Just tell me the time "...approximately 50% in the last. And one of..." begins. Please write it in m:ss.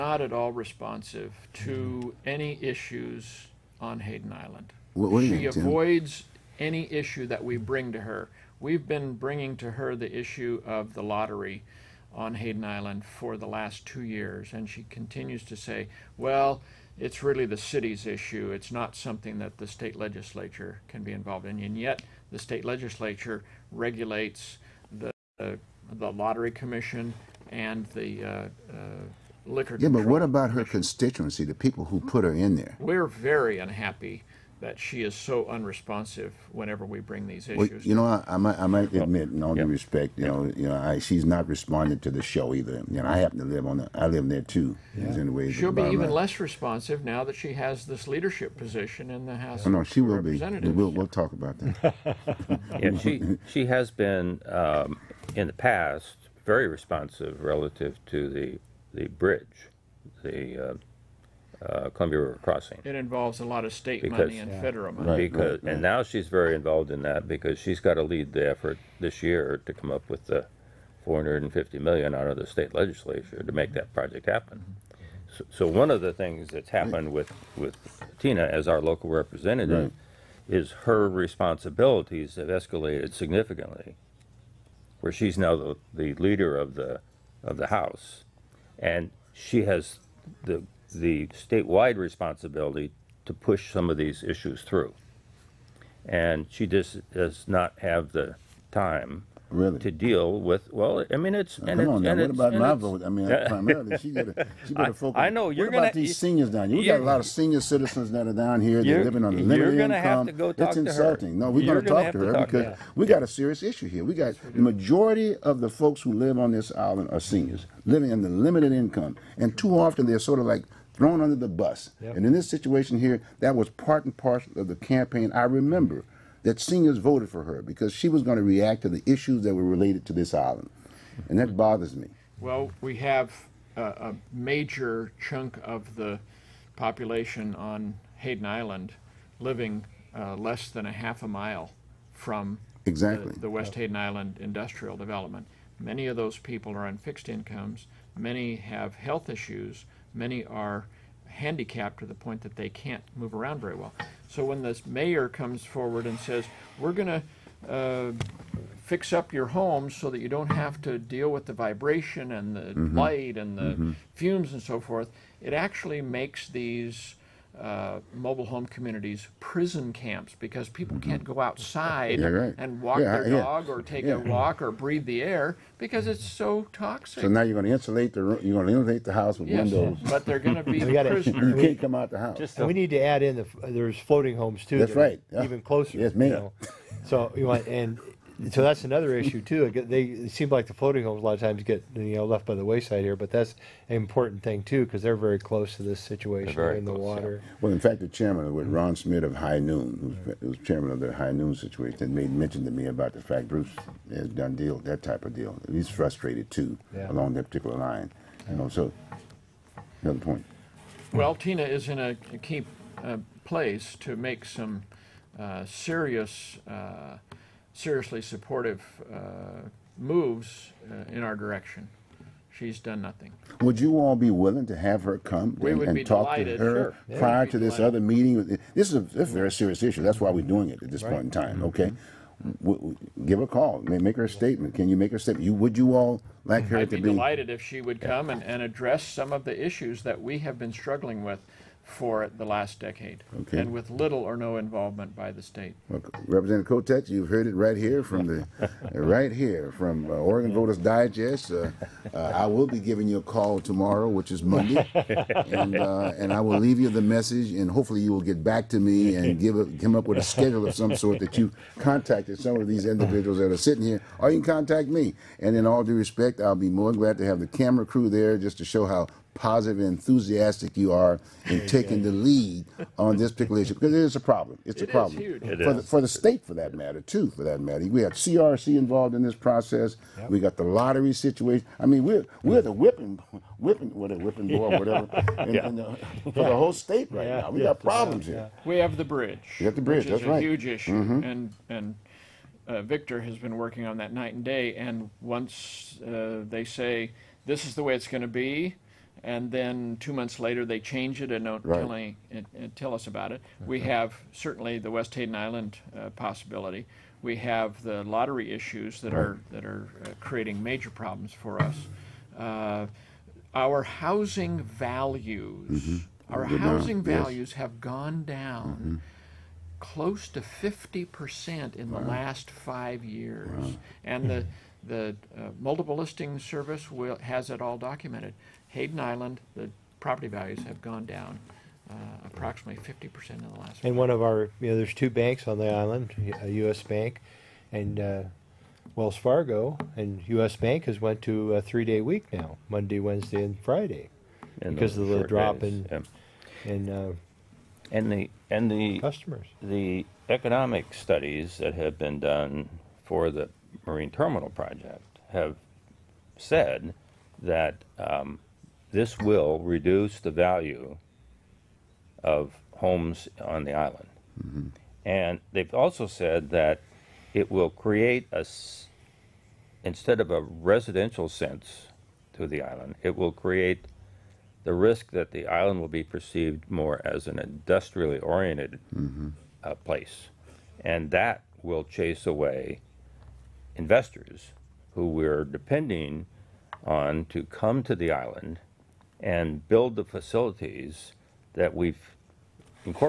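5:32.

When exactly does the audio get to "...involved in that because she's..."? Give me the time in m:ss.
1:06.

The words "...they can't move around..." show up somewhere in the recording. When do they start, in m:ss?
2:32.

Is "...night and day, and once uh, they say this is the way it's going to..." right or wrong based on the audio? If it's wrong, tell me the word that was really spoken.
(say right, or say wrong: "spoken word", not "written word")
right.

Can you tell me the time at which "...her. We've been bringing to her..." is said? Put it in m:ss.
0:08.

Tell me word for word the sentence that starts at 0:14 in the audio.
And she continues to say, well, it's really the city's issue.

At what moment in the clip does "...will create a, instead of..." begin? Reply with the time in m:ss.
6:07.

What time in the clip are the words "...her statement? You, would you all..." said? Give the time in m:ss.
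3:55.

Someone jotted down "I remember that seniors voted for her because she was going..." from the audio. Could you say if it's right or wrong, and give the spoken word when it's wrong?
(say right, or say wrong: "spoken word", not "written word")
right.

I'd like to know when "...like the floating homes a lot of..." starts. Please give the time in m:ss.
3:10.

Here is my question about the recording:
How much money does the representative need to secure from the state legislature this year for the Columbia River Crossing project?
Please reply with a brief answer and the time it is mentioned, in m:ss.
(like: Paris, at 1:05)
$450 million, at 1:11.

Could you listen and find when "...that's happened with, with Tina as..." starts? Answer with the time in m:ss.
1:16.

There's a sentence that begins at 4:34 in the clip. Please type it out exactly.
It's it a problem for the, for the state, for that matter, too.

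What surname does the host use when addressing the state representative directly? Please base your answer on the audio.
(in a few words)
Kotek.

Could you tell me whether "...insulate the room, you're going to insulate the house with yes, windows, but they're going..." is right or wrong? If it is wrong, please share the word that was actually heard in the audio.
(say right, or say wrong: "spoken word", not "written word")
right.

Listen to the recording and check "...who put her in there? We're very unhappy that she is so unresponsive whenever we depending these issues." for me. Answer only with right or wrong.
wrong.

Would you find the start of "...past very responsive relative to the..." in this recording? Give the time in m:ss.
0:55.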